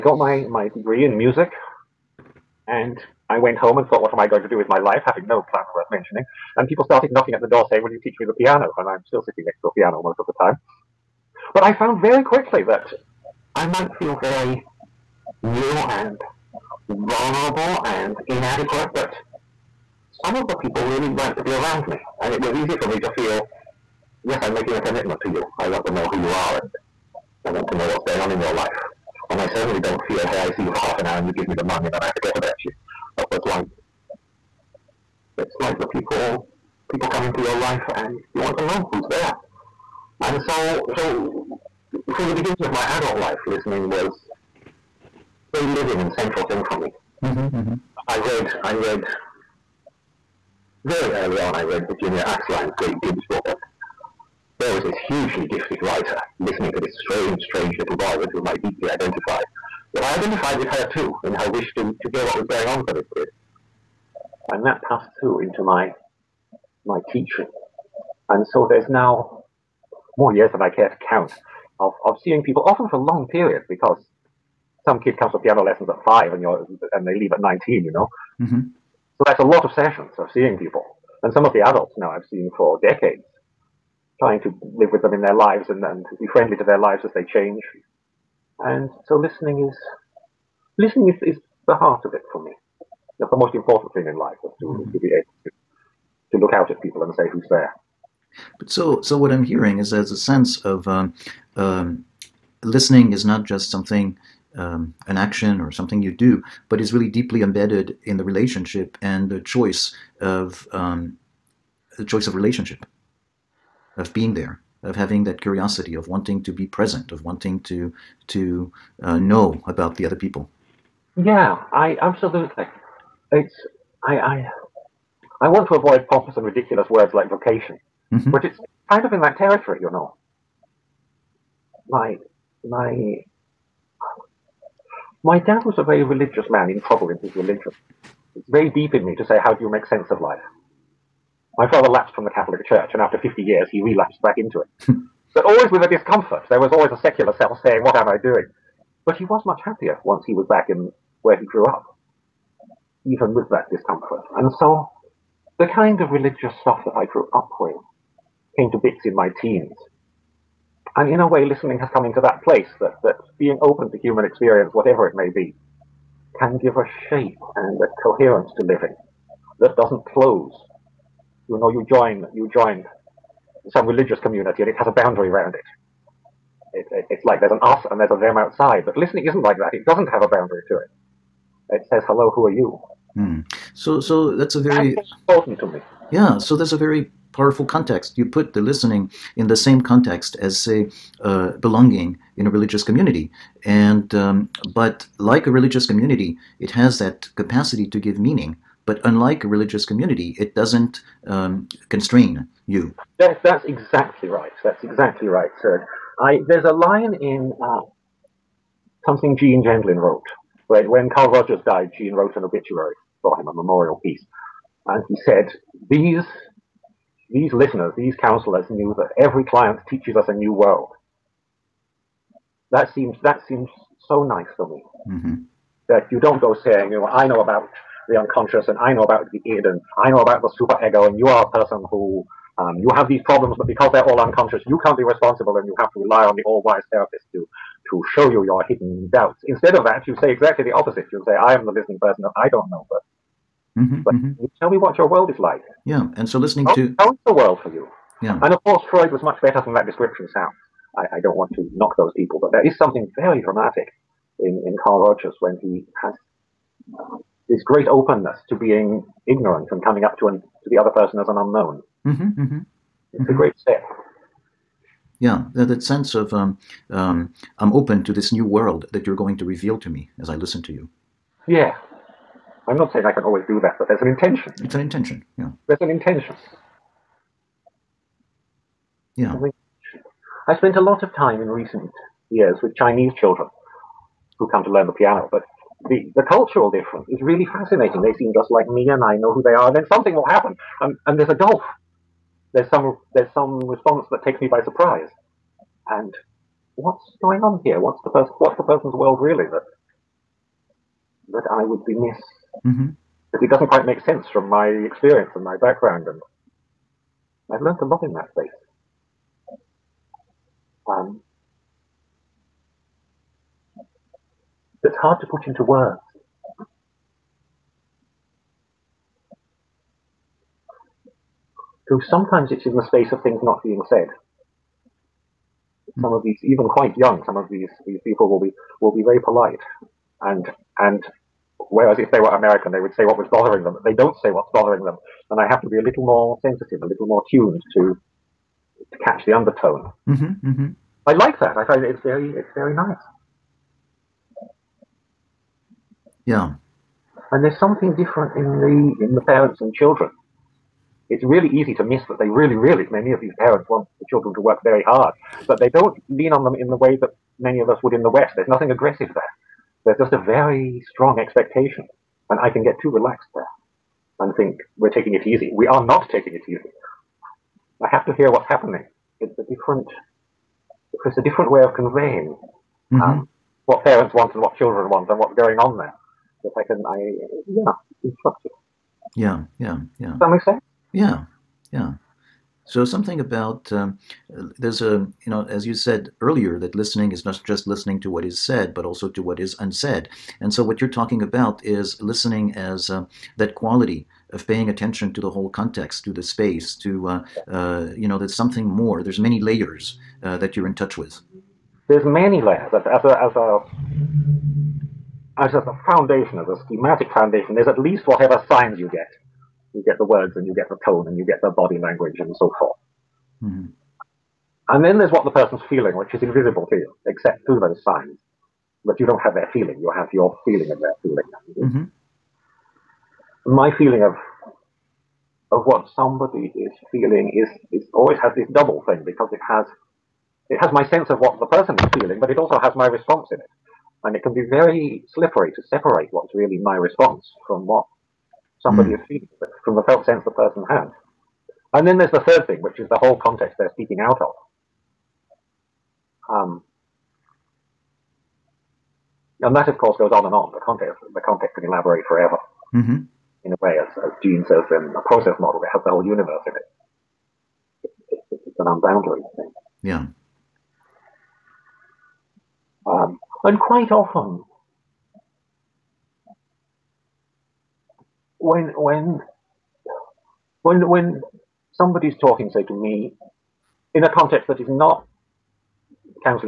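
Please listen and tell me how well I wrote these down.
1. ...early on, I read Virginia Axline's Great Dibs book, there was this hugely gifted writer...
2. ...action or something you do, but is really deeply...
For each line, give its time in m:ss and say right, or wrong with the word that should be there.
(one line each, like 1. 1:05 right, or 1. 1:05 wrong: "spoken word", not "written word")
1. 0:51 right
2. 1:45 right.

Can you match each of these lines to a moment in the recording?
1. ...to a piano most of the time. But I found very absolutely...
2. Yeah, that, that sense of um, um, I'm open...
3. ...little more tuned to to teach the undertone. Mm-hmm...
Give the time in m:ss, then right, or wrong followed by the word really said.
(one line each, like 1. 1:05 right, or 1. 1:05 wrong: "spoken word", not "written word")
1. 0:09 wrong: "quickly", not "absolutely"
2. 4:25 right
3. 5:36 wrong: "catch", not "teach".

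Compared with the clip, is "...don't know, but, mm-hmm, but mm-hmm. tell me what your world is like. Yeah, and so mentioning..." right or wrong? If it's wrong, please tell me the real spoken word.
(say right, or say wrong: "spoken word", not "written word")
wrong: "listening", not "mentioning".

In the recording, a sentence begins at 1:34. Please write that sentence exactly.
to be able to look out at people and say who's there.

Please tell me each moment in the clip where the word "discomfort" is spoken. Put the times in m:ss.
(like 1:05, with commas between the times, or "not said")
2:25, 2:33.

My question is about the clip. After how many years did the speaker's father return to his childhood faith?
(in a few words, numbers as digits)
50 years.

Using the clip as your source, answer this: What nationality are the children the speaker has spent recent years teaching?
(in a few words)
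Chinese.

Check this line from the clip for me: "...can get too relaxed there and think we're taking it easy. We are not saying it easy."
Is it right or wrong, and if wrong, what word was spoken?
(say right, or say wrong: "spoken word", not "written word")
wrong: "taking", not "saying".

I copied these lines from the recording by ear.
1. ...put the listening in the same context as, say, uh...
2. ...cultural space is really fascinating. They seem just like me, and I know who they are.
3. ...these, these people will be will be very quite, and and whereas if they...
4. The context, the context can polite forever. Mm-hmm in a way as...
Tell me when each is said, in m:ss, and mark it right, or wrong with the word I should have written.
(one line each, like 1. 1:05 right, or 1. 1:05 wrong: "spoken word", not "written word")
1. 3:08 right
2. 4:46 wrong: "difference", not "space"
3. 5:27 wrong: "polite", not "quite"
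4. 7:30 wrong: "elaborate", not "polite".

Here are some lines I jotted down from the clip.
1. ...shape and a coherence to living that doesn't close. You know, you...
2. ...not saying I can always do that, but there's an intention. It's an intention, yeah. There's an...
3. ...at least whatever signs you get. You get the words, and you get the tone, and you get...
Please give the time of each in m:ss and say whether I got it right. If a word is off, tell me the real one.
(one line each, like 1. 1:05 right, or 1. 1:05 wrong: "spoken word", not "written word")
1. 2:47 right
2. 4:32 right
3. 6:47 right.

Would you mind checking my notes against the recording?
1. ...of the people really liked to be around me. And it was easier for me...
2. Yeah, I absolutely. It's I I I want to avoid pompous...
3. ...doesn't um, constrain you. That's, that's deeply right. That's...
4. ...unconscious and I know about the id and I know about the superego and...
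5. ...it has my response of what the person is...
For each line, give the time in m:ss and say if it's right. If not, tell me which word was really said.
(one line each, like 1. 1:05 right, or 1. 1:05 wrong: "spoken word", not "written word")
1. 0:20 right
2. 2:01 right
3. 3:20 wrong: "exactly", not "deeply"
4. 3:48 right
5. 7:10 wrong: "sense", not "response".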